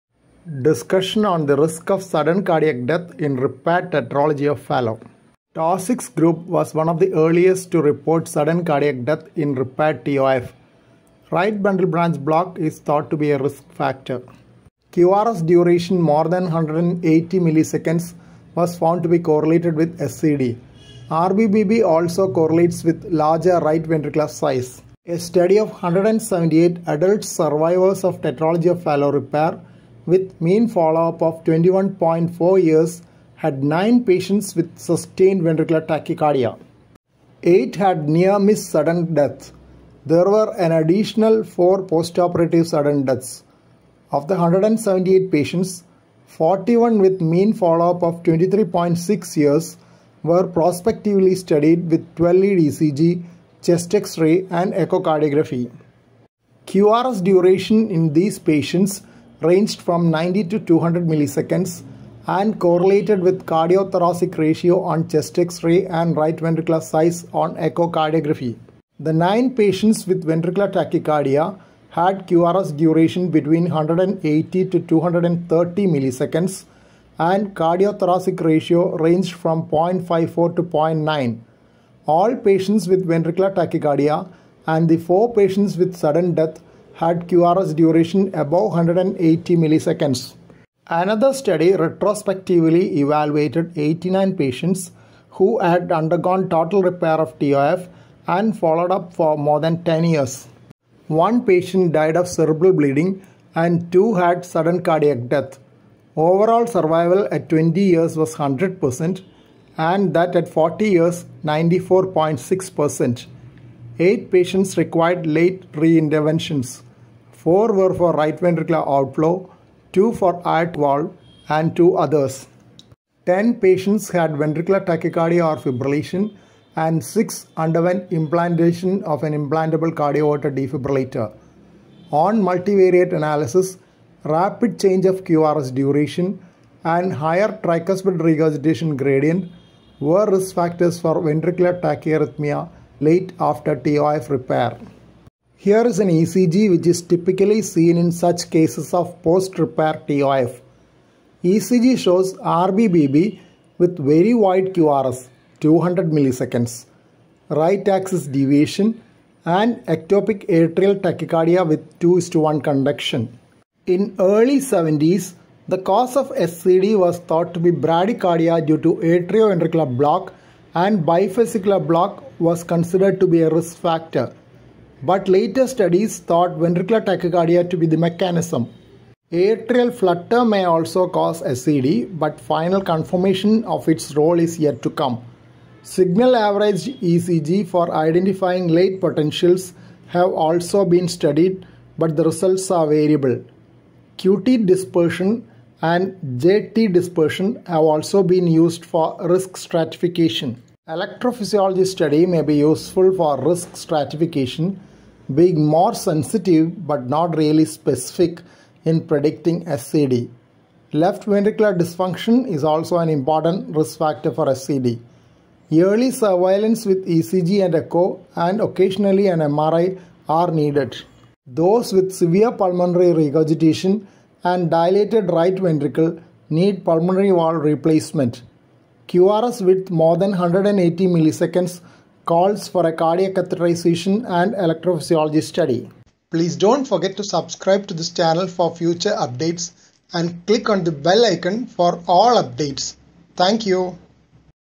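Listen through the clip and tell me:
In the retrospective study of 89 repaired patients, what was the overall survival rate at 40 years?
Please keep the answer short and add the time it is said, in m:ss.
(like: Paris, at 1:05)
94.6%, at 1:51.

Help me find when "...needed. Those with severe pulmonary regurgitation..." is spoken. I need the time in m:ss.
3:40.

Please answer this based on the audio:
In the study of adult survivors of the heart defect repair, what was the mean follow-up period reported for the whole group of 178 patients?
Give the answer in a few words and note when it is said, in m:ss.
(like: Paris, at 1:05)
21.4 years, at 0:31.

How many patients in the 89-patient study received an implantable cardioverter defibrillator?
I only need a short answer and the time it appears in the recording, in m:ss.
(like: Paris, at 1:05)
6, at 2:07.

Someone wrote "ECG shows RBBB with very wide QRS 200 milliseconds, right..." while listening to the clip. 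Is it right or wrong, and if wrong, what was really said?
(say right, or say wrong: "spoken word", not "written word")
right.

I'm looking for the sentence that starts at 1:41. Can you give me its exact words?
One patient died of cerebral bleeding and two had sudden cardiac death.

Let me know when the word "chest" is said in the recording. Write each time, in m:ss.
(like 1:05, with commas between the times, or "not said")
0:53, 1:05.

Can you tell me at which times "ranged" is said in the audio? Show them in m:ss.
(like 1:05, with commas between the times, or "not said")
0:59, 1:18.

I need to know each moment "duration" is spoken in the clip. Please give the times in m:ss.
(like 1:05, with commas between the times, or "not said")
0:15, 0:57, 1:12, 1:27, 2:15.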